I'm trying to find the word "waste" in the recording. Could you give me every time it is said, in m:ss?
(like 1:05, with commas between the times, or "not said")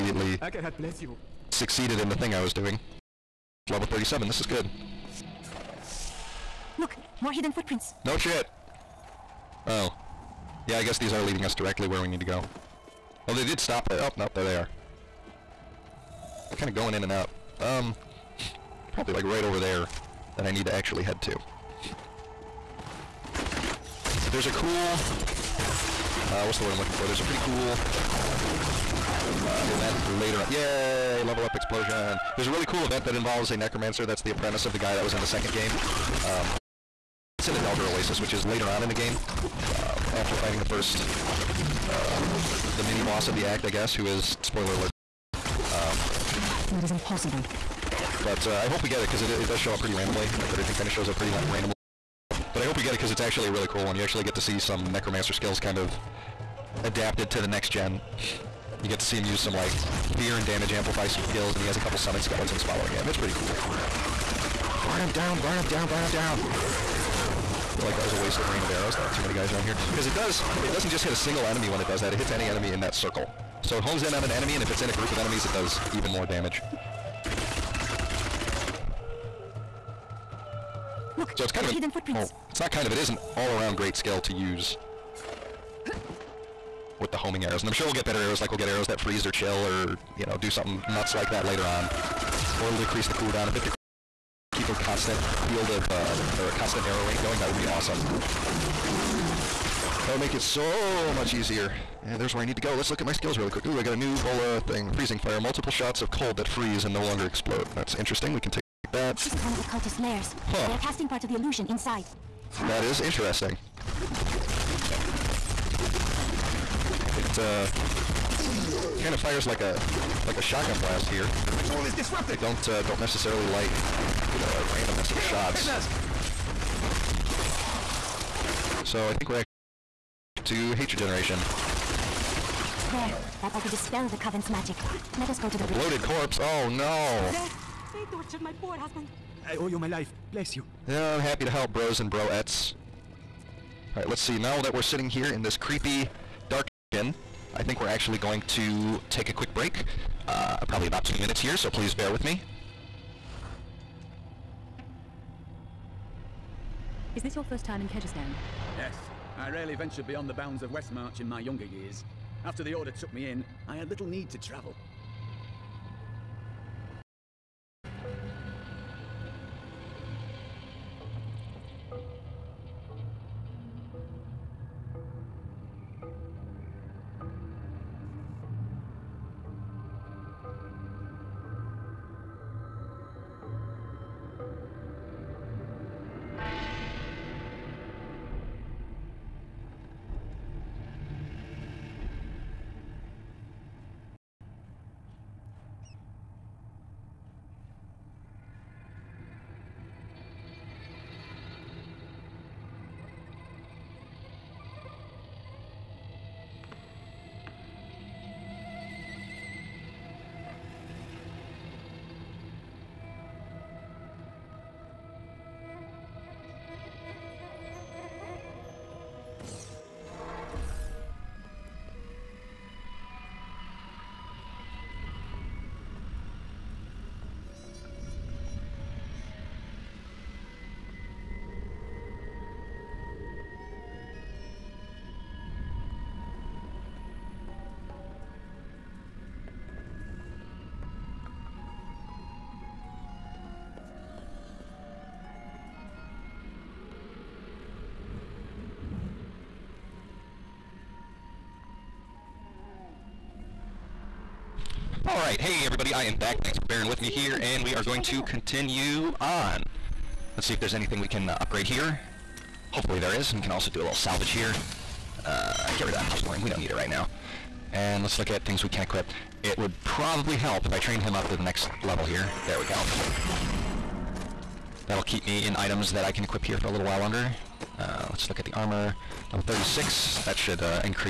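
1:08.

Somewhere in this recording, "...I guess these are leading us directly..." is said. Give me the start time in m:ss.
0:10.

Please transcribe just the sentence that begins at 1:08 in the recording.
There aren't too many guys around here.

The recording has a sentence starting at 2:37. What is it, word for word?
Is this your first time in Kehjistan?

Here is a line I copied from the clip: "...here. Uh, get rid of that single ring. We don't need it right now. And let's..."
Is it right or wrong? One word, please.
wrong.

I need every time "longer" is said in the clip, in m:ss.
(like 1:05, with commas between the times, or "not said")
1:47, 4:36.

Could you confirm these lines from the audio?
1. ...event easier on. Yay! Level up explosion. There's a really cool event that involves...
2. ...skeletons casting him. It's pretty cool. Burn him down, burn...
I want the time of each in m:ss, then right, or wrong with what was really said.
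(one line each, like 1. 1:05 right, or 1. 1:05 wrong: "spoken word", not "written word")
1. 0:29 wrong: "later", not "easier"
2. 1:02 wrong: "following", not "casting".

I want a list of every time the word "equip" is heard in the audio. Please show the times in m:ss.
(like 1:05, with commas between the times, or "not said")
4:28, 4:36.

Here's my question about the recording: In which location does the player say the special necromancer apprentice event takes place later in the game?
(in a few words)
Dahlgur Oasis.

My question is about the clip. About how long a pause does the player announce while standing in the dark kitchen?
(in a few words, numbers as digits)
2 minutes.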